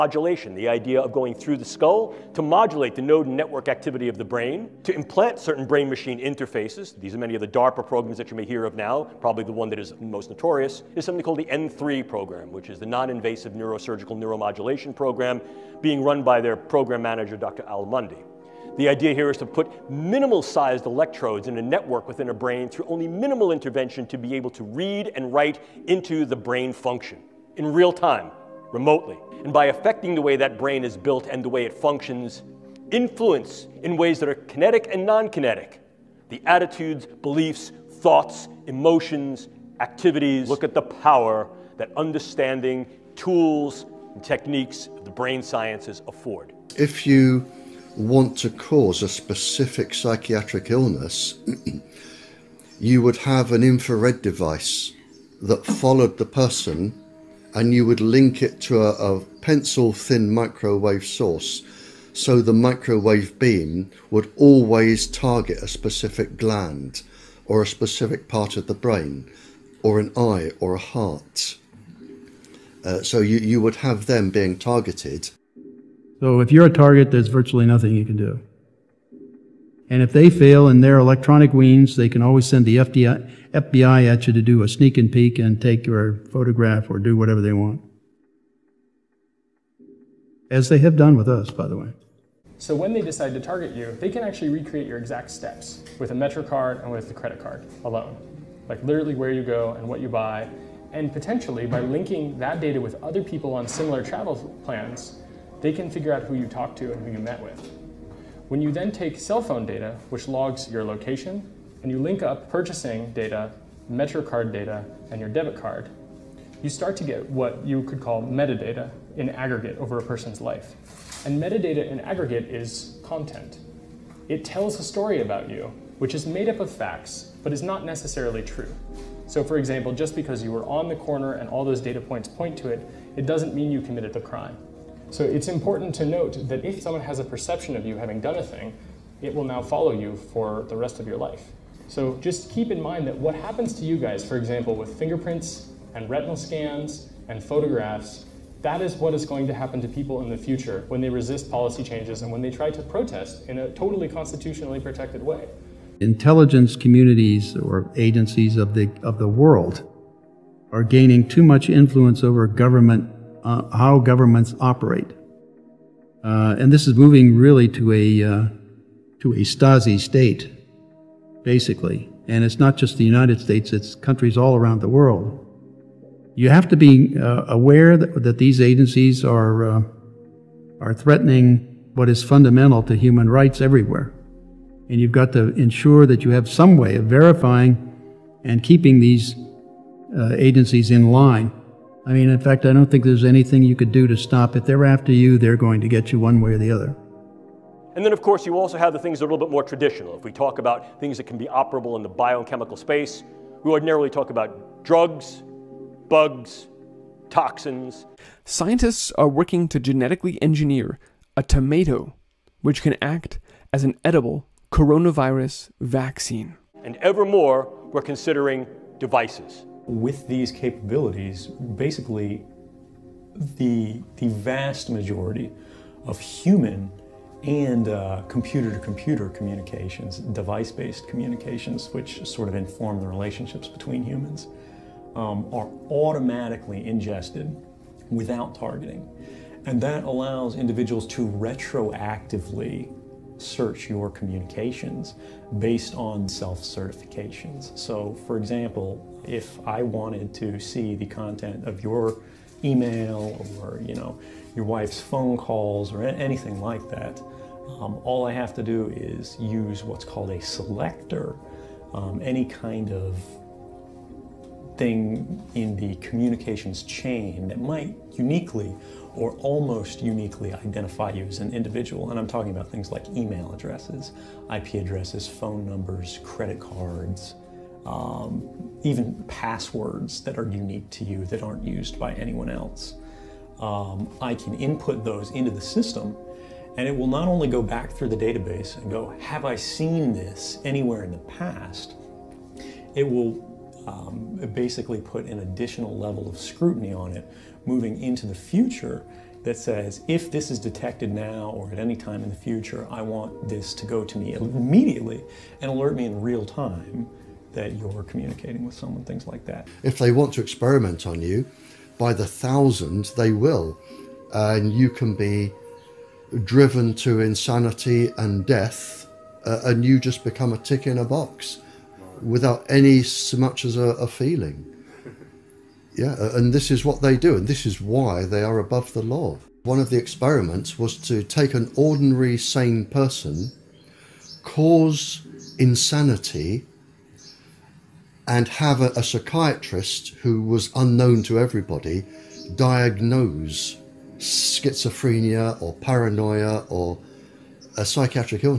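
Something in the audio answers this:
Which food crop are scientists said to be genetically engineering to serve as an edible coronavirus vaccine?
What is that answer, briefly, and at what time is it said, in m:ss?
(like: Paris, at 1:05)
Tomato, at 3:31.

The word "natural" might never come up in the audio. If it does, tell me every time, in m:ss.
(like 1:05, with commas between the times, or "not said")
not said.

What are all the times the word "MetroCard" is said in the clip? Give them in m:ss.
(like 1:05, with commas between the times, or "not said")
1:36, 1:53.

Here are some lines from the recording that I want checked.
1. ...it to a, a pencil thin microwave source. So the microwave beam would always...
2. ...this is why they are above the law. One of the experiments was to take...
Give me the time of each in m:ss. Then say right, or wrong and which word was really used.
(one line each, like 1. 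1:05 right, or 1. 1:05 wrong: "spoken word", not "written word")
1. 0:58 right
2. 5:27 right.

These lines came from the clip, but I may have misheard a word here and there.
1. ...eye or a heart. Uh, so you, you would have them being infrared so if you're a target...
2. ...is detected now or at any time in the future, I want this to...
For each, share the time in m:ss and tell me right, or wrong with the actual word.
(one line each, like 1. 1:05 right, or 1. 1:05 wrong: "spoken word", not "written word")
1. 1:10 wrong: "targeted", not "infrared"
2. 5:00 right.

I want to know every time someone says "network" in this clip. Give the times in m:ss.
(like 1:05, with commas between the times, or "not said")
0:03, 0:21.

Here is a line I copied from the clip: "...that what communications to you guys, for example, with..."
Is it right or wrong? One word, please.
wrong.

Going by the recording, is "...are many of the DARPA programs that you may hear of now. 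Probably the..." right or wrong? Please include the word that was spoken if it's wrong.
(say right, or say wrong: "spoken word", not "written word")
right.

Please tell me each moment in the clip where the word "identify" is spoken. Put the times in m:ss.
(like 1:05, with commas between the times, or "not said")
4:30.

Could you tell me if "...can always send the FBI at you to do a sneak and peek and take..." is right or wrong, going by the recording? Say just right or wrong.
right.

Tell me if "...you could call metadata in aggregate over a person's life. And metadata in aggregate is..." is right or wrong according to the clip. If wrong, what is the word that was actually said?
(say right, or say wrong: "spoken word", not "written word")
right.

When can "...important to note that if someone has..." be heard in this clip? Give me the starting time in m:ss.
2:15.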